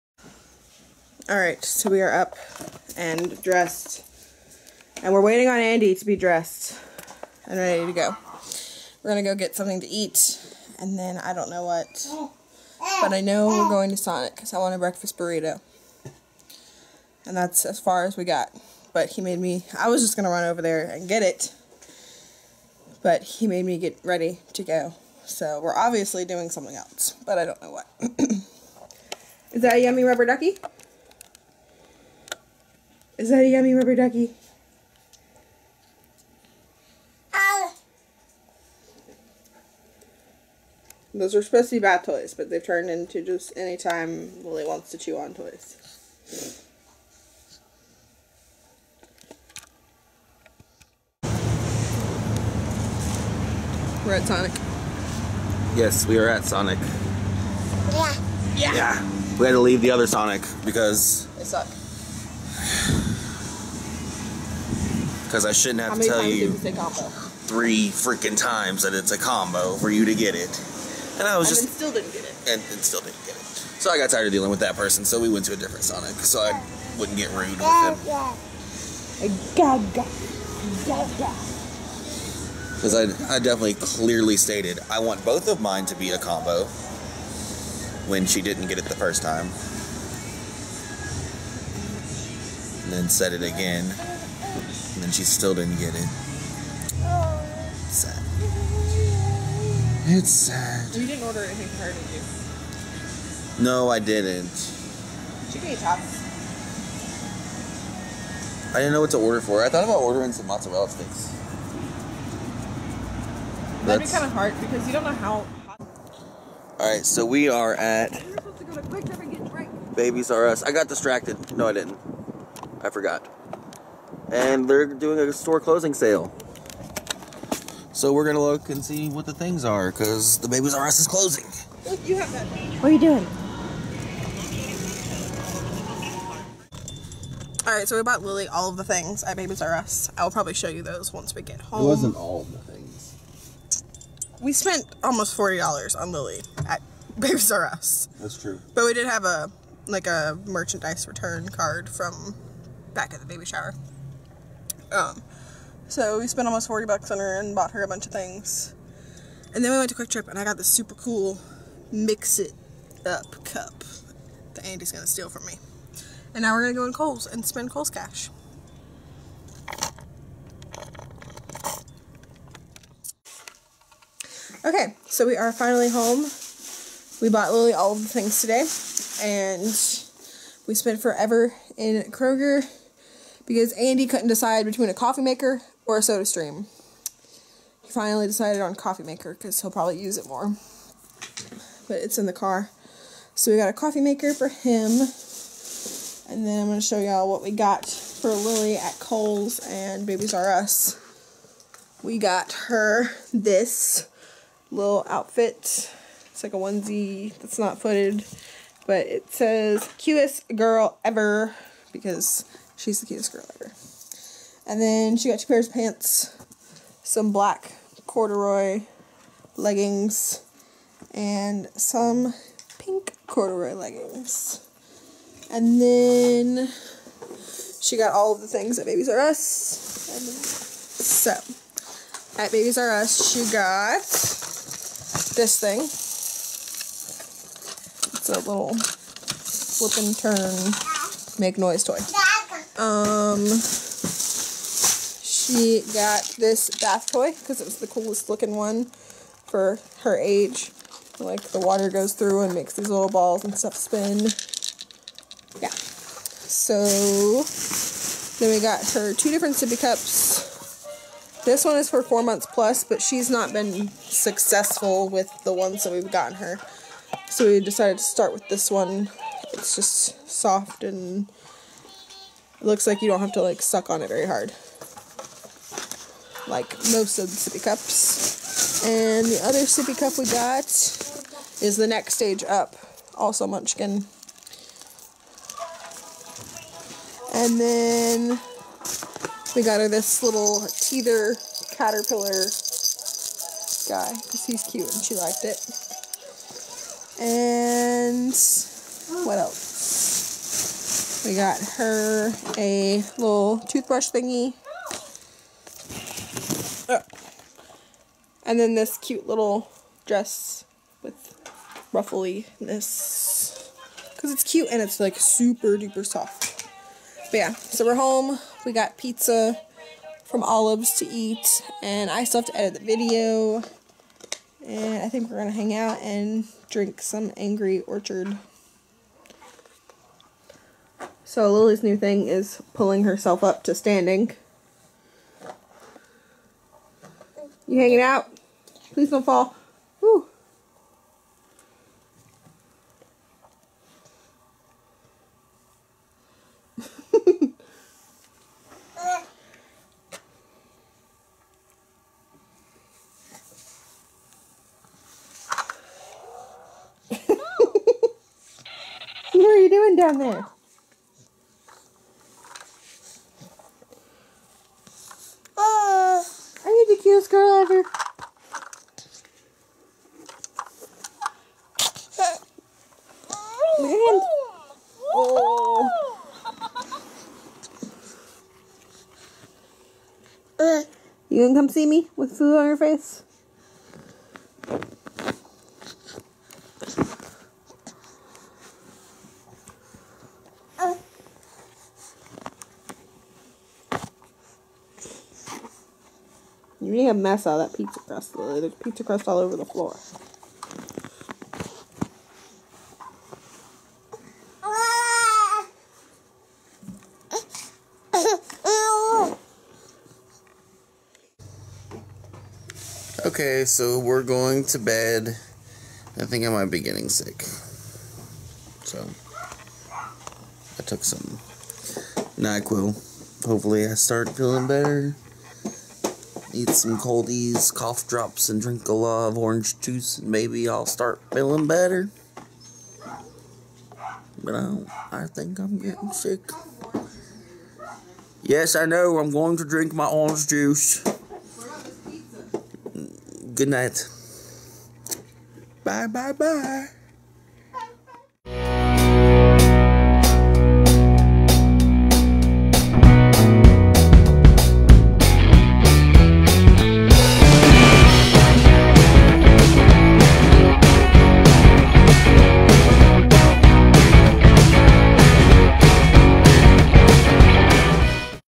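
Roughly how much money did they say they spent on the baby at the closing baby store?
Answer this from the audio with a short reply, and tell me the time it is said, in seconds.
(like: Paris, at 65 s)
40 dollars, at 145 s.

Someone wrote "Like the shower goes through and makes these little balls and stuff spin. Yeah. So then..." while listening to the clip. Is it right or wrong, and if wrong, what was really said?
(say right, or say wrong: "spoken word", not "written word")
wrong: "water", not "shower".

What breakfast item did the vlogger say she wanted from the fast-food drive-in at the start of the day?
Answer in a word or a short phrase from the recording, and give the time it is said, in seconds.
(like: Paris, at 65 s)
Breakfast burrito, at 14 s.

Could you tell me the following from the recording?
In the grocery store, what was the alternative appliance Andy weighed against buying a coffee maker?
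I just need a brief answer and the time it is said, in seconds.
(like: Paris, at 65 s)
Soda stream, at 186 s.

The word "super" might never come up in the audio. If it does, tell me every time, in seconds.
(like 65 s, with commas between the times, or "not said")
160 s, 315 s.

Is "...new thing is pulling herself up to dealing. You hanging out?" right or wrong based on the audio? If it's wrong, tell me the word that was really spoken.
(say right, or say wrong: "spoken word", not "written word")
wrong: "standing", not "dealing".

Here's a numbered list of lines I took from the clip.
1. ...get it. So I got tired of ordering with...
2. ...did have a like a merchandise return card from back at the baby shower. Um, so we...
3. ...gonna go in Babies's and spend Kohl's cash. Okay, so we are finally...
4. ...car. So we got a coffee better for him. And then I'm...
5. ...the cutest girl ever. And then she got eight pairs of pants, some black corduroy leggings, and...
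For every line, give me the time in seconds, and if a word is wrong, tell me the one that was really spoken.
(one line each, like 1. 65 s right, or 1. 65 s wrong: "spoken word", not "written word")
1. 73 s wrong: "dealing", not "ordering"
2. 148 s right
3. 166 s wrong: "Kohl", not "Babies"
4. 192 s wrong: "maker", not "better"
5. 212 s wrong: "two", not "eight".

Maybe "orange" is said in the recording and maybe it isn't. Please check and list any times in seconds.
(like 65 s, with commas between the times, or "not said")
429 s, 440 s.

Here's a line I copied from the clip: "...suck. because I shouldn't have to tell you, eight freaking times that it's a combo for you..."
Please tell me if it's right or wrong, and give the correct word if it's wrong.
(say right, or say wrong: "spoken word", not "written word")
wrong: "three", not "eight".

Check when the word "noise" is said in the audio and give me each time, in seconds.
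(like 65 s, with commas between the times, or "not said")
241 s.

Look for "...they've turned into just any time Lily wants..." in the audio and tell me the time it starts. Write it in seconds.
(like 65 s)
42 s.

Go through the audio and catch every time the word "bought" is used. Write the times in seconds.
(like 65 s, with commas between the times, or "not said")
138 s, 157 s, 177 s.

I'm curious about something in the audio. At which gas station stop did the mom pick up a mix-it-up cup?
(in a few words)
QuikTrip.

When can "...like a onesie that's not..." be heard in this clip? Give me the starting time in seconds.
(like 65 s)
206 s.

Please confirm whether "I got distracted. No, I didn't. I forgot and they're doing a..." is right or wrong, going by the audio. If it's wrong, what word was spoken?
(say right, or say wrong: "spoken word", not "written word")
right.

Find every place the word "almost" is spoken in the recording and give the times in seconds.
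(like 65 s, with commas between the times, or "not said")
145 s, 156 s.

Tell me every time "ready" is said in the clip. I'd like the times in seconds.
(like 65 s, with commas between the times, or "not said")
7 s, 24 s.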